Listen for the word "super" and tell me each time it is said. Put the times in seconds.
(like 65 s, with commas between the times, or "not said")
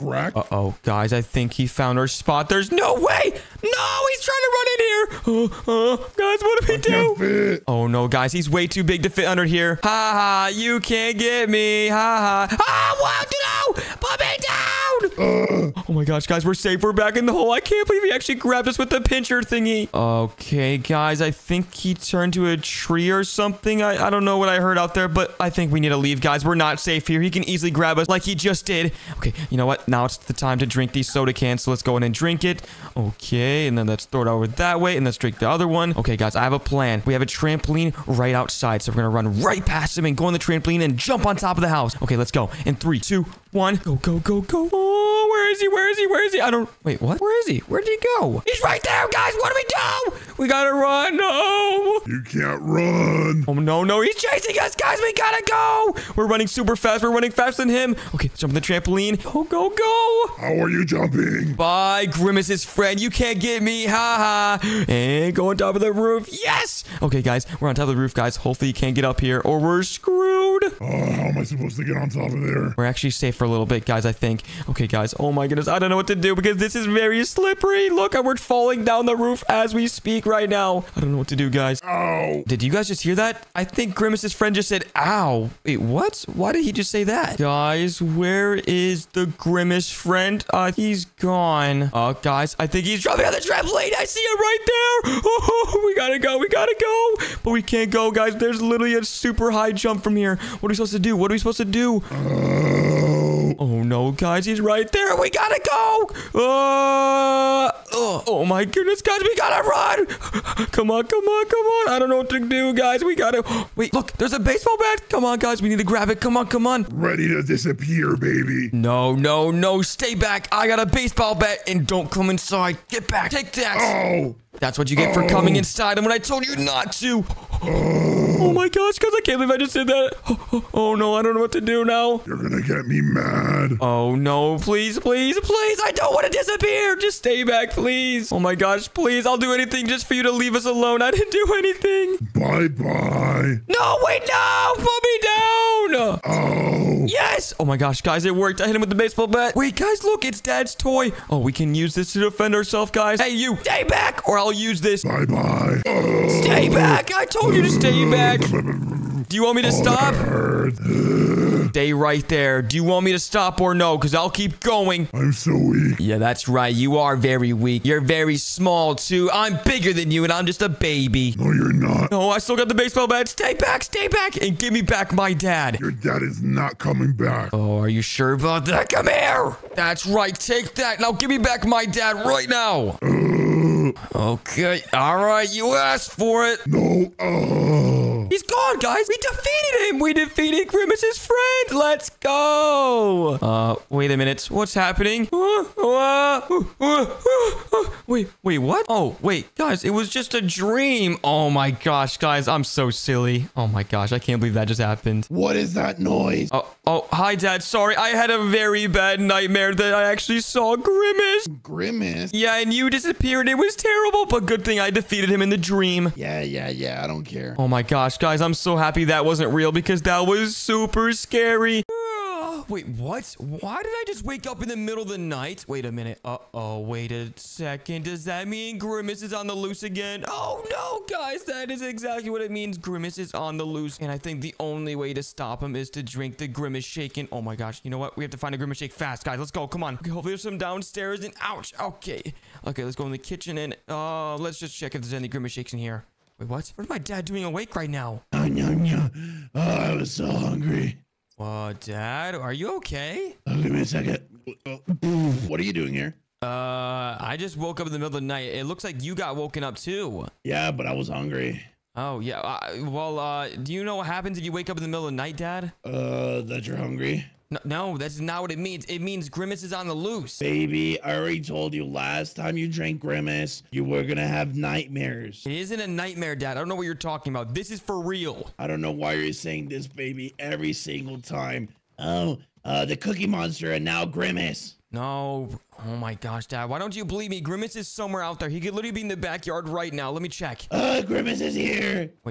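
56 s, 99 s, 220 s.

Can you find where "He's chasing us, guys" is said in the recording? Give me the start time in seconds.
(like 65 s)
54 s.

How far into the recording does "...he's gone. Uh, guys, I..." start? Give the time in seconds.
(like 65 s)
90 s.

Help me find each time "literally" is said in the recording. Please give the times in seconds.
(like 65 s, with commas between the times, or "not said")
98 s, 288 s.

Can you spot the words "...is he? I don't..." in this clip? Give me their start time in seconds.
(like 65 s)
46 s.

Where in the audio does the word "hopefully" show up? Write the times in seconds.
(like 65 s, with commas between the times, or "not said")
68 s, 240 s.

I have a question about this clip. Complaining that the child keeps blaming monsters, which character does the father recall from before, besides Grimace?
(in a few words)
Cookie Monster.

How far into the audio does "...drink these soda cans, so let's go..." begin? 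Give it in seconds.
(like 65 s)
30 s.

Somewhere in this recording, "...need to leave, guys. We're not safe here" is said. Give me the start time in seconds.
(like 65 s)
25 s.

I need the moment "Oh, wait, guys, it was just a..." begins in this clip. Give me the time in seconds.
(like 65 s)
198 s.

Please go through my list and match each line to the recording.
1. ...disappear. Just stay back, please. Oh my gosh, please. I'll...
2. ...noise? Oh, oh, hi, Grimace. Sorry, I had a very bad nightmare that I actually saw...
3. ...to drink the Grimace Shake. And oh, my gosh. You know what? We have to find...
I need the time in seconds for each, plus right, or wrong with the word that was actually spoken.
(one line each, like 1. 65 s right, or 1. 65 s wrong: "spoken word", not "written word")
1. 136 s right
2. 205 s wrong: "Dad", not "Grimace"
3. 235 s right.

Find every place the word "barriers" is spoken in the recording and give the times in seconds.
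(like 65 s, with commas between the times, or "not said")
not said.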